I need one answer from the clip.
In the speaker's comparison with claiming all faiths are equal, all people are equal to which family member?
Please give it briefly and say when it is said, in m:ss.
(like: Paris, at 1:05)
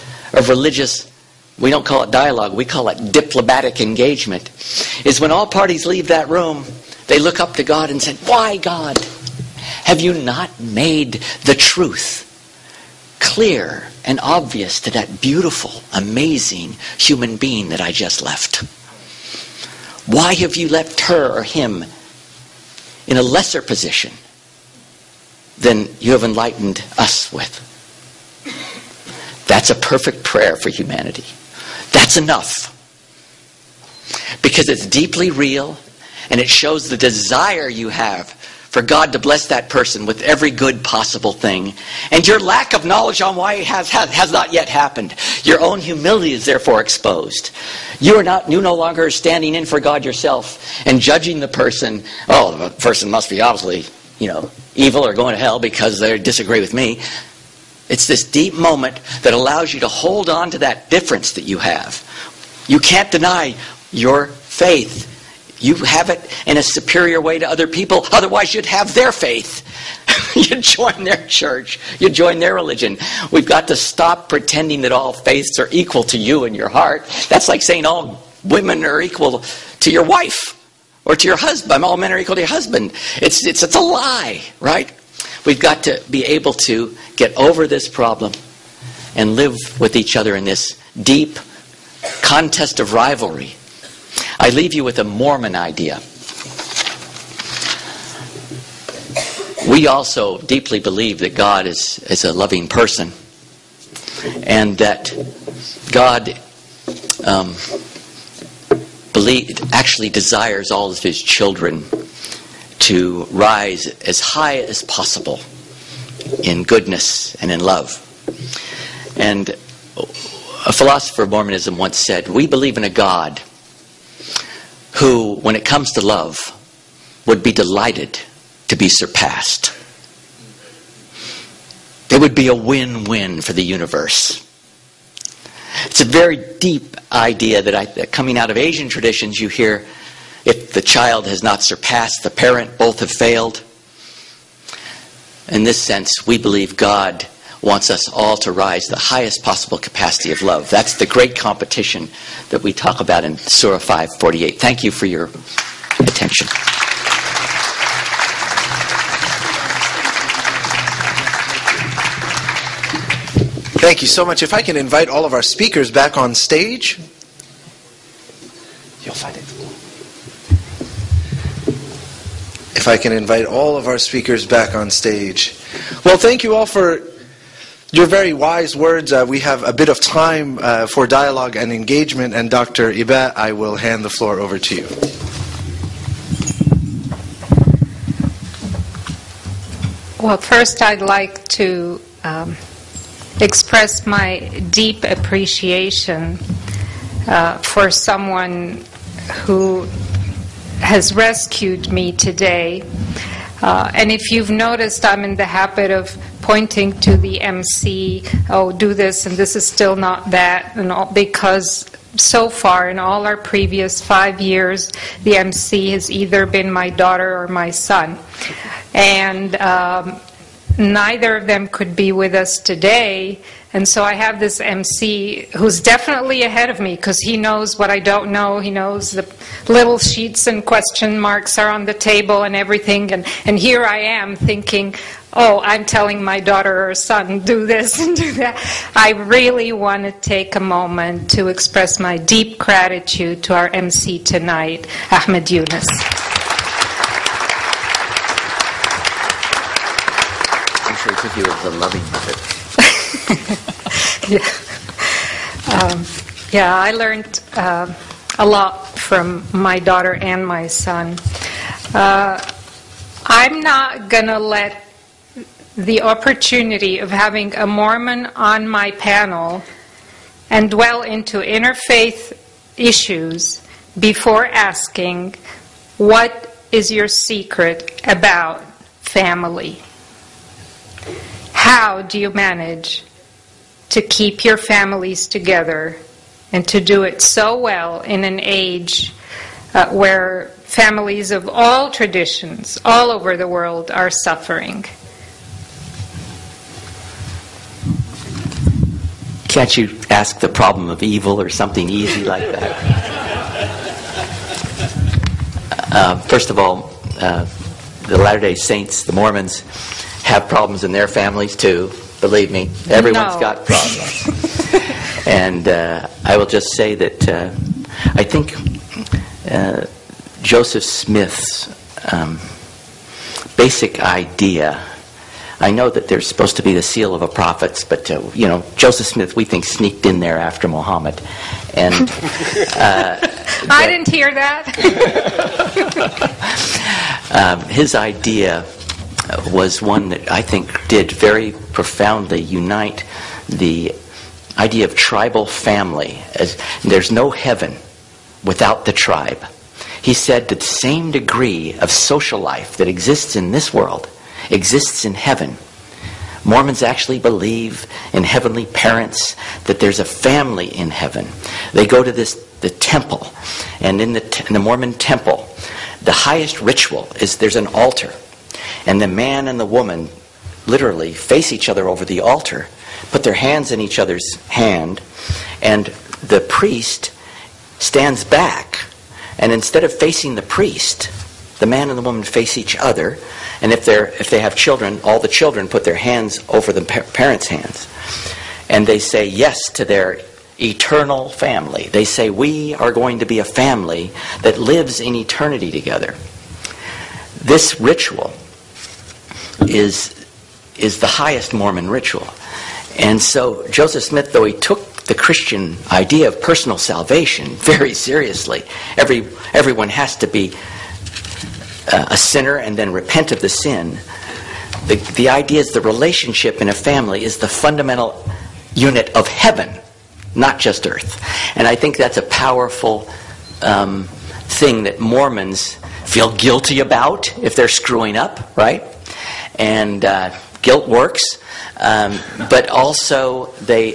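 Your wife, at 1:19.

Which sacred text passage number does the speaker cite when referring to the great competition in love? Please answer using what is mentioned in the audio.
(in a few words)
Surah 548.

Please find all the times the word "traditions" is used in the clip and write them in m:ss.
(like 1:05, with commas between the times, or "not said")
2:18, 4:51.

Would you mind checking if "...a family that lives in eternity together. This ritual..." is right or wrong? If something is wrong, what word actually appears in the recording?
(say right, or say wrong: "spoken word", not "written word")
right.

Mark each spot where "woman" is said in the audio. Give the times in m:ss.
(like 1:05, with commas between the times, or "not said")
6:09, 6:22.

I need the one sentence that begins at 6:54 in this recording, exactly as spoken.
The, the idea is the relationship in a family is the fundamental unit of heaven, not just earth.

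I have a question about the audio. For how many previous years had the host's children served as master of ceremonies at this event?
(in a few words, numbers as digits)
5.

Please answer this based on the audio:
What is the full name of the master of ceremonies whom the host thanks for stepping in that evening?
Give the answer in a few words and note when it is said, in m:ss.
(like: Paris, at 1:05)
Ahmed Yunus, at 4:05.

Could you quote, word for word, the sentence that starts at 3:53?
And, and here I am thinking, oh, I'm telling my daughter or son, do this and do that.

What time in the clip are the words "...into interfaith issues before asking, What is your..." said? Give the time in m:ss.
4:31.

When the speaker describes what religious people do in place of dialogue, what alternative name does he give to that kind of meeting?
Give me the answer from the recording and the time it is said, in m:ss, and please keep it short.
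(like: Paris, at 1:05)
Diplomatic engagement, at 0:03.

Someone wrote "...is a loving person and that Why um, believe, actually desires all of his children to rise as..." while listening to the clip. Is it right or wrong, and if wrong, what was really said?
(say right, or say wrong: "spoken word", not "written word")
wrong: "God", not "Why".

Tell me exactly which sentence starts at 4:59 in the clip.
Can't you ask the problem of evil or something easy like that?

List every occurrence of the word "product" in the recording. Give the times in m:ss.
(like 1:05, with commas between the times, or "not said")
not said.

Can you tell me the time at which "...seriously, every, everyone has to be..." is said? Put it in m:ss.
6:47.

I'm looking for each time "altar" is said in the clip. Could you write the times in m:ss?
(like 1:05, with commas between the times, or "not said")
6:07, 6:12.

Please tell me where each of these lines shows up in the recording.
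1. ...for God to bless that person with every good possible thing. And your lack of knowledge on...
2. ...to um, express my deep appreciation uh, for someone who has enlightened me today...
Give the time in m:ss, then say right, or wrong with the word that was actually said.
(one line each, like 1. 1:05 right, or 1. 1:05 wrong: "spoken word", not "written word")
1. 0:38 right
2. 3:11 wrong: "rescued", not "enlightened".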